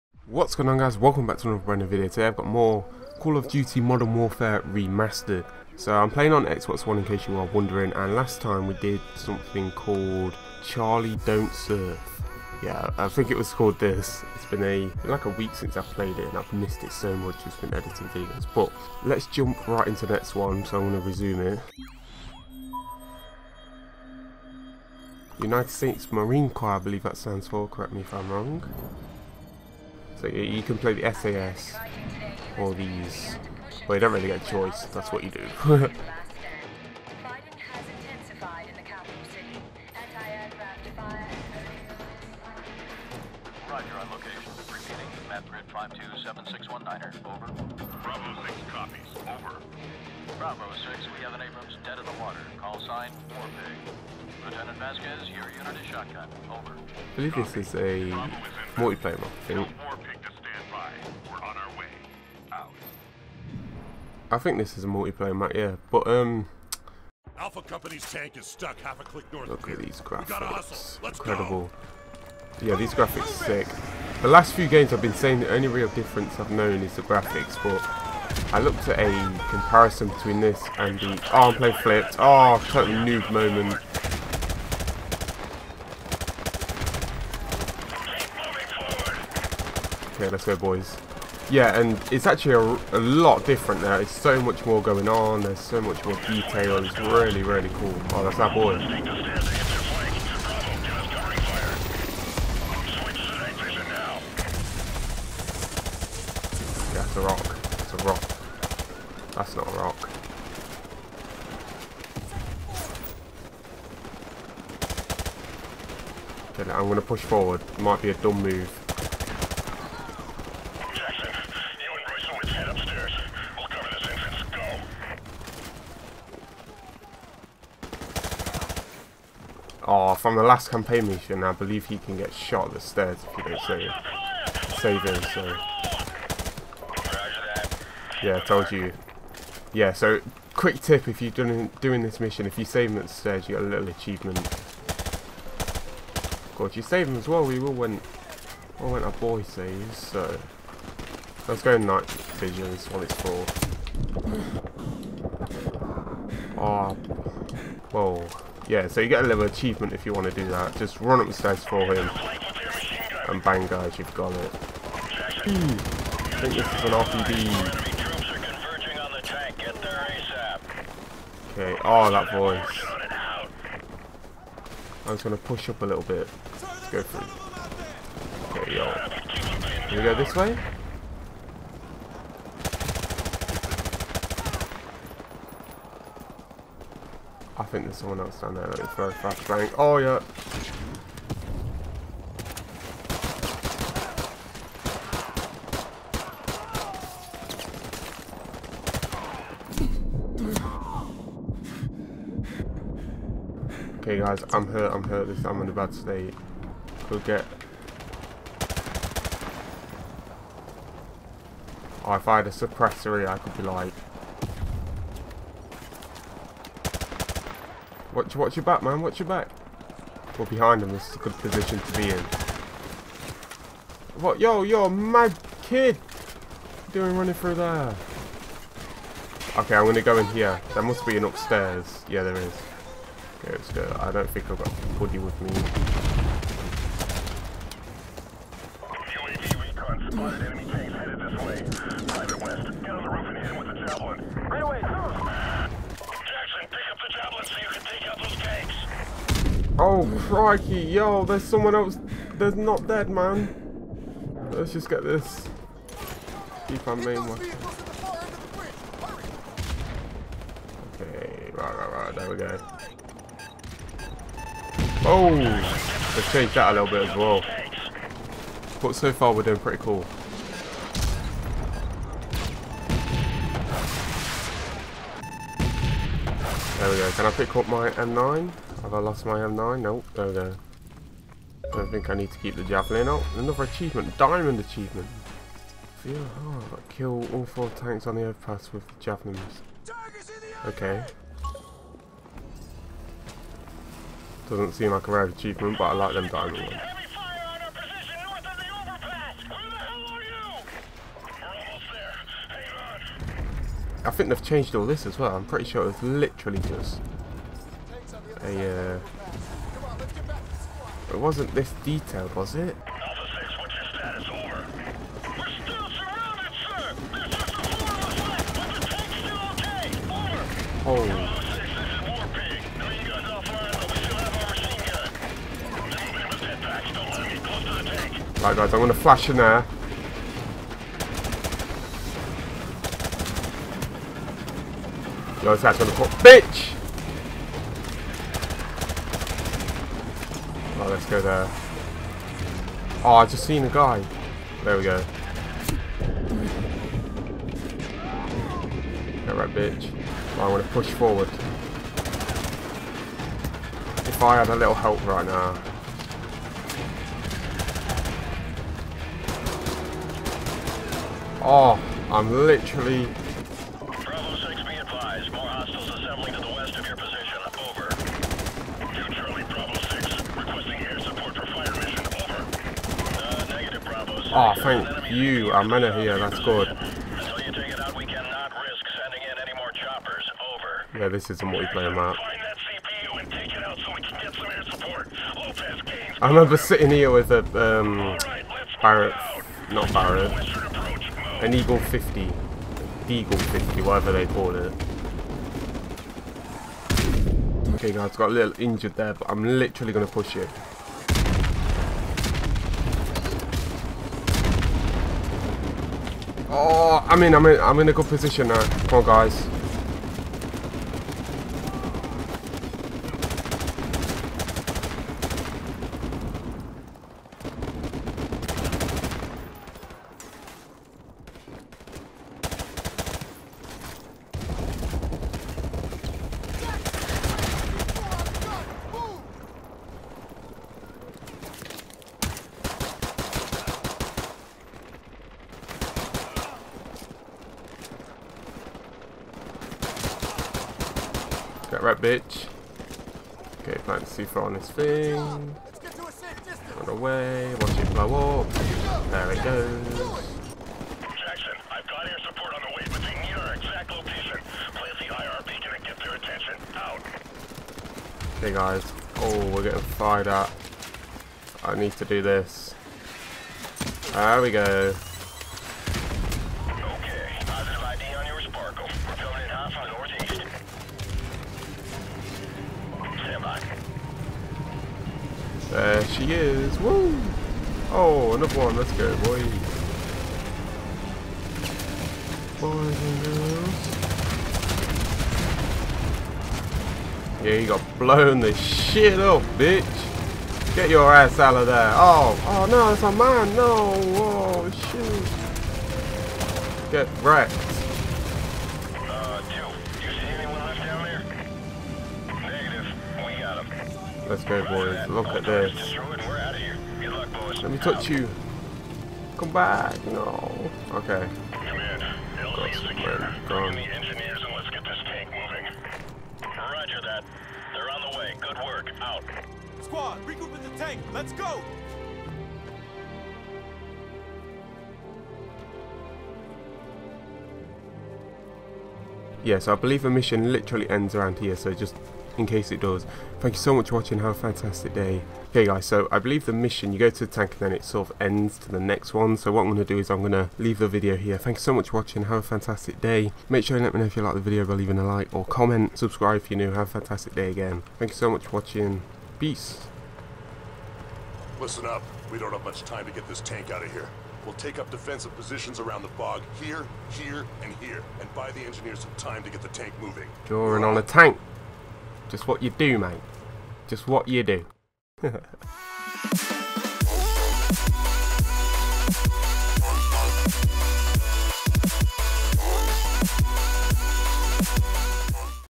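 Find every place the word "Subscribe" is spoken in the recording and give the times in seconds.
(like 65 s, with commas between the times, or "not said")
545 s.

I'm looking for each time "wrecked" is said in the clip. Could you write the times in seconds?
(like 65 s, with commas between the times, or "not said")
497 s.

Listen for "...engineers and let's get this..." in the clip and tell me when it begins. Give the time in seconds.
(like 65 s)
513 s.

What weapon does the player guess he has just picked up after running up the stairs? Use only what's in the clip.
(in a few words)
RPD.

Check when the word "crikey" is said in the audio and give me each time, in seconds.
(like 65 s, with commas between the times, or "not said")
250 s.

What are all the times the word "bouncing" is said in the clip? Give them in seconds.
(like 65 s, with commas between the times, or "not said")
not said.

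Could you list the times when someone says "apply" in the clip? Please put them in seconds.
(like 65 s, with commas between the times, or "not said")
not said.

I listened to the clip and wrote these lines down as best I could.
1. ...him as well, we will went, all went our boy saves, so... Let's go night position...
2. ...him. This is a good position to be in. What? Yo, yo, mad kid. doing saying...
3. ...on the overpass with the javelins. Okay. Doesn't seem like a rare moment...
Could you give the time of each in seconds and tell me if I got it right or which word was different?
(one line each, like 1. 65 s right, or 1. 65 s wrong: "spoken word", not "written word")
1. 147 s wrong: "vision", not "position"
2. 220 s wrong: "running", not "saying"
3. 288 s wrong: "achievement", not "moment".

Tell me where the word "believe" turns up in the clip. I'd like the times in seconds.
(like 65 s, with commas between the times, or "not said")
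26 s, 57 s, 131 s, 529 s, 536 s.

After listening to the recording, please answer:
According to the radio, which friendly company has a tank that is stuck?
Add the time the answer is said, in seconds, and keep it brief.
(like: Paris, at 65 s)
Alpha Company, at 67 s.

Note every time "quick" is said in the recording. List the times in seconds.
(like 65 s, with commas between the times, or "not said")
140 s.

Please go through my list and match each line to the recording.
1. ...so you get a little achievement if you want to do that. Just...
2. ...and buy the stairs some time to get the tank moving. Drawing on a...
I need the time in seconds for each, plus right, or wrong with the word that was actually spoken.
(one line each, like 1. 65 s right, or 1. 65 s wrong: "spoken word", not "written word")
1. 158 s right
2. 558 s wrong: "engineers", not "stairs".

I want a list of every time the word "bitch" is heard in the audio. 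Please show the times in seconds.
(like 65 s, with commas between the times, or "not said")
336 s, 349 s, 489 s.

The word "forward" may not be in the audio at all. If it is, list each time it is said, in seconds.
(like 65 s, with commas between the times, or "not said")
117 s, 350 s.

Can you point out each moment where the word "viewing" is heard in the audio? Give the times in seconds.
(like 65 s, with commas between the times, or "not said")
not said.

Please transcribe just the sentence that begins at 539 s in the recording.
So what I'm going to do is I'm going to leave the video here.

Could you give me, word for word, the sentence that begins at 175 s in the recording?
I'm just going to push up a little bit.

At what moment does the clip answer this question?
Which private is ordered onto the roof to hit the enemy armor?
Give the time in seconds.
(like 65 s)
242 s.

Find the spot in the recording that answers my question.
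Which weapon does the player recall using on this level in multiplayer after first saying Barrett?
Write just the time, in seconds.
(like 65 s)
393 s.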